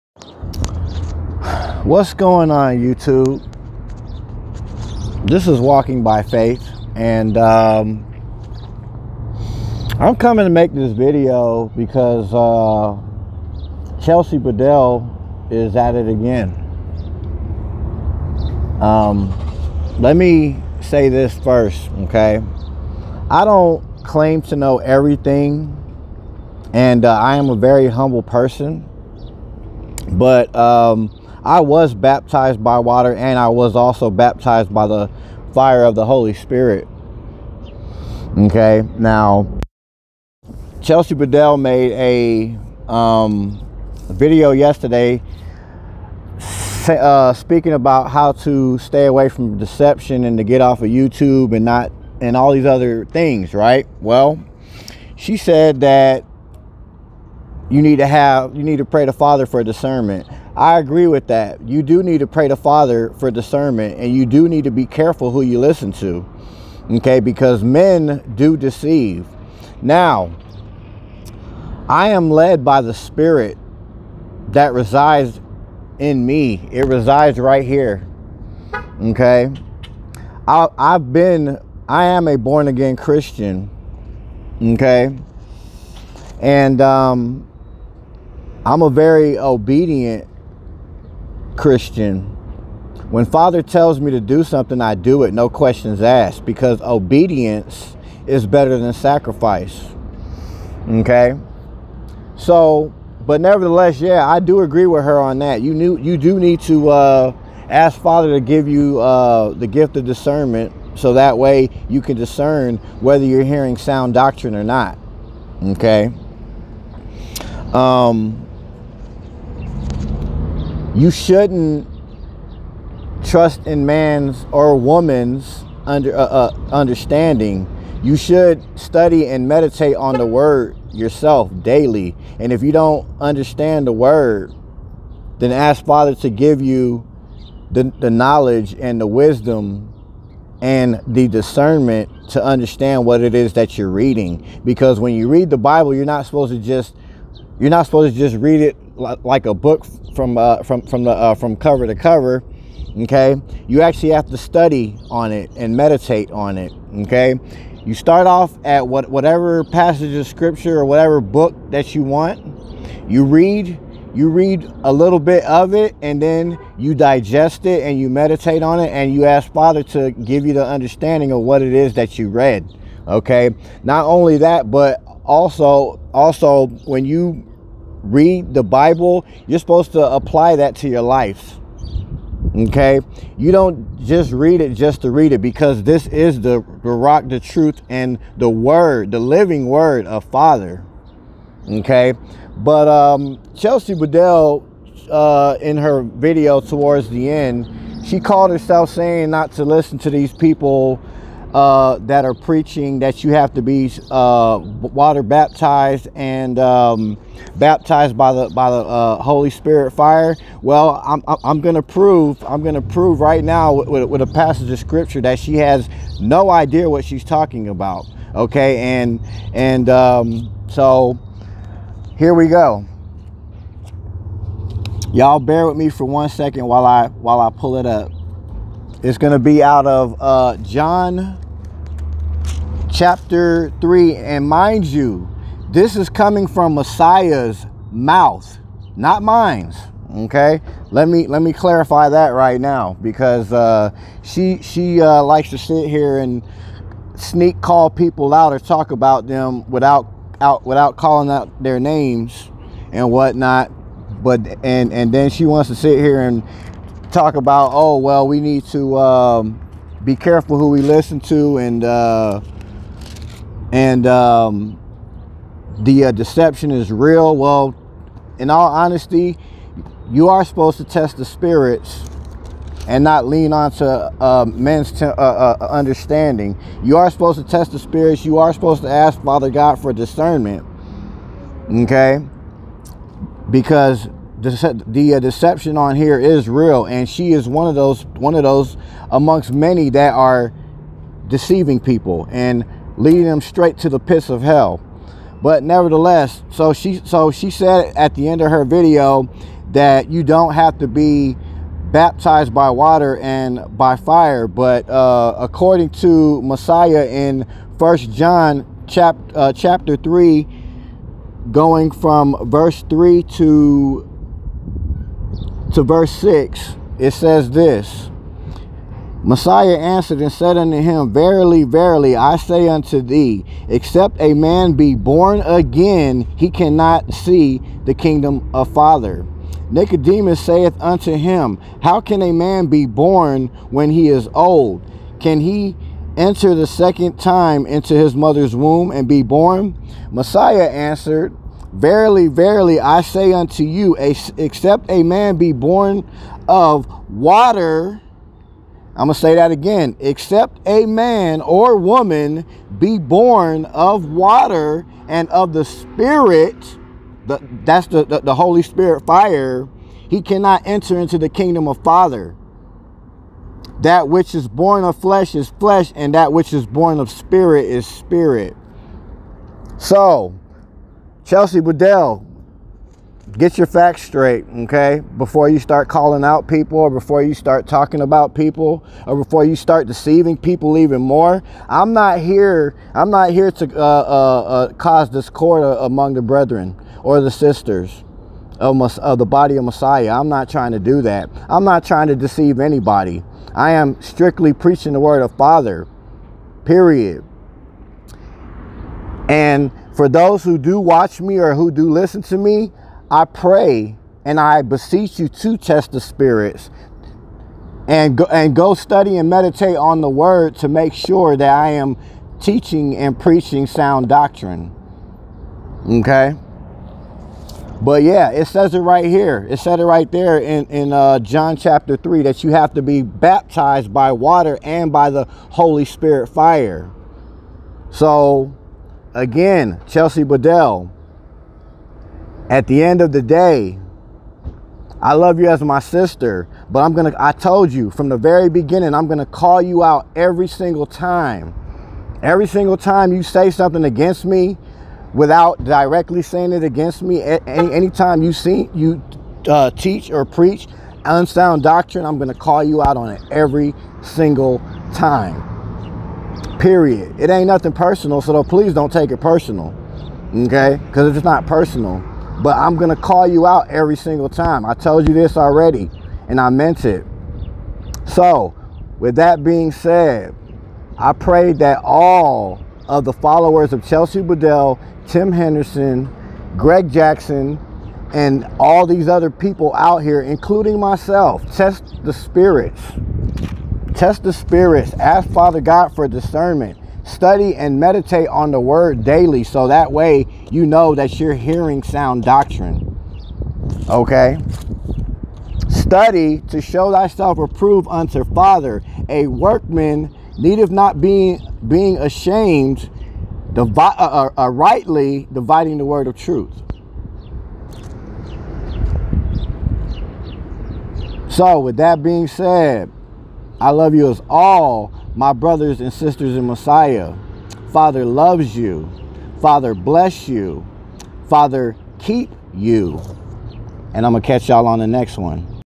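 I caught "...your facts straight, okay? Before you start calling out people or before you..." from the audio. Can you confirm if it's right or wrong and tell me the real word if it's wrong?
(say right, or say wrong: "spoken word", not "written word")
right.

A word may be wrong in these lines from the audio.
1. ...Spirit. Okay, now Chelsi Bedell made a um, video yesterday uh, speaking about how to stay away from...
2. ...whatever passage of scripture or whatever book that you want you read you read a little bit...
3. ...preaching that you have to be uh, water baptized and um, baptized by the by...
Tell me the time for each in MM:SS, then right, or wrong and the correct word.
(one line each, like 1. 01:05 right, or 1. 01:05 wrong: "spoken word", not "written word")
1. 00:36 right
2. 02:39 right
3. 03:22 right.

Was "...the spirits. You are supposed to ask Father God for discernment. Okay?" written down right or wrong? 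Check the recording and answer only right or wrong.
right.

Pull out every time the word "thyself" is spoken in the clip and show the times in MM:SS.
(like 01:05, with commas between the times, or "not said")
08:16.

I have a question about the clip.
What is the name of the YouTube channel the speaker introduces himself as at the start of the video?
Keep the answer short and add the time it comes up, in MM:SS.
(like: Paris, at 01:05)
Walking by Faith, at 00:05.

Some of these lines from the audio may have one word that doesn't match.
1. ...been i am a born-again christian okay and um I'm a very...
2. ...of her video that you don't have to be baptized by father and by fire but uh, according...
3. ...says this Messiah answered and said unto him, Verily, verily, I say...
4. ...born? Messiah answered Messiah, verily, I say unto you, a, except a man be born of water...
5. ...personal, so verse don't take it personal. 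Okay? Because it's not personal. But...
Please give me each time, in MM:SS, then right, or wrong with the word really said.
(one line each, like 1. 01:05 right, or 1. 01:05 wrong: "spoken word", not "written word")
1. 01:21 right
2. 04:58 wrong: "water", not "father"
3. 05:17 right
4. 05:39 wrong: "Verily", not "Messiah"
5. 07:37 wrong: "please", not "verse".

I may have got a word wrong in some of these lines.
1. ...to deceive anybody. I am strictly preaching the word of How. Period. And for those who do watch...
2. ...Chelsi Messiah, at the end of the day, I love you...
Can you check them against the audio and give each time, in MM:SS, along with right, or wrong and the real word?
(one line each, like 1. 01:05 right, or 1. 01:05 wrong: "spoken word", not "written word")
1. 06:32 wrong: "Father", not "How"
2. 07:09 wrong: "Bedell", not "Messiah".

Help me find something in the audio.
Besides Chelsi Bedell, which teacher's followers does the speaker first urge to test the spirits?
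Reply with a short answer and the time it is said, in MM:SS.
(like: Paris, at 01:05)
Tim Henderson, at 07:55.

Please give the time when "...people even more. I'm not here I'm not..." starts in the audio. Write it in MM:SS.
06:20.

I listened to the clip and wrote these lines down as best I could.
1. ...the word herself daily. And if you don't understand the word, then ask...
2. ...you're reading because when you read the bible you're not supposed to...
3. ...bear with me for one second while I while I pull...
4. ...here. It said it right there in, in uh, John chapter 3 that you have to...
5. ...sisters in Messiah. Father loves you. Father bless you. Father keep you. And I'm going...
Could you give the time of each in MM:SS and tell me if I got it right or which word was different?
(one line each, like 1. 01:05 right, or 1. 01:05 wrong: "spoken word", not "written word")
1. 02:10 wrong: "yourself", not "herself"
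2. 02:23 right
3. 03:45 right
4. 06:59 right
5. 08:35 right.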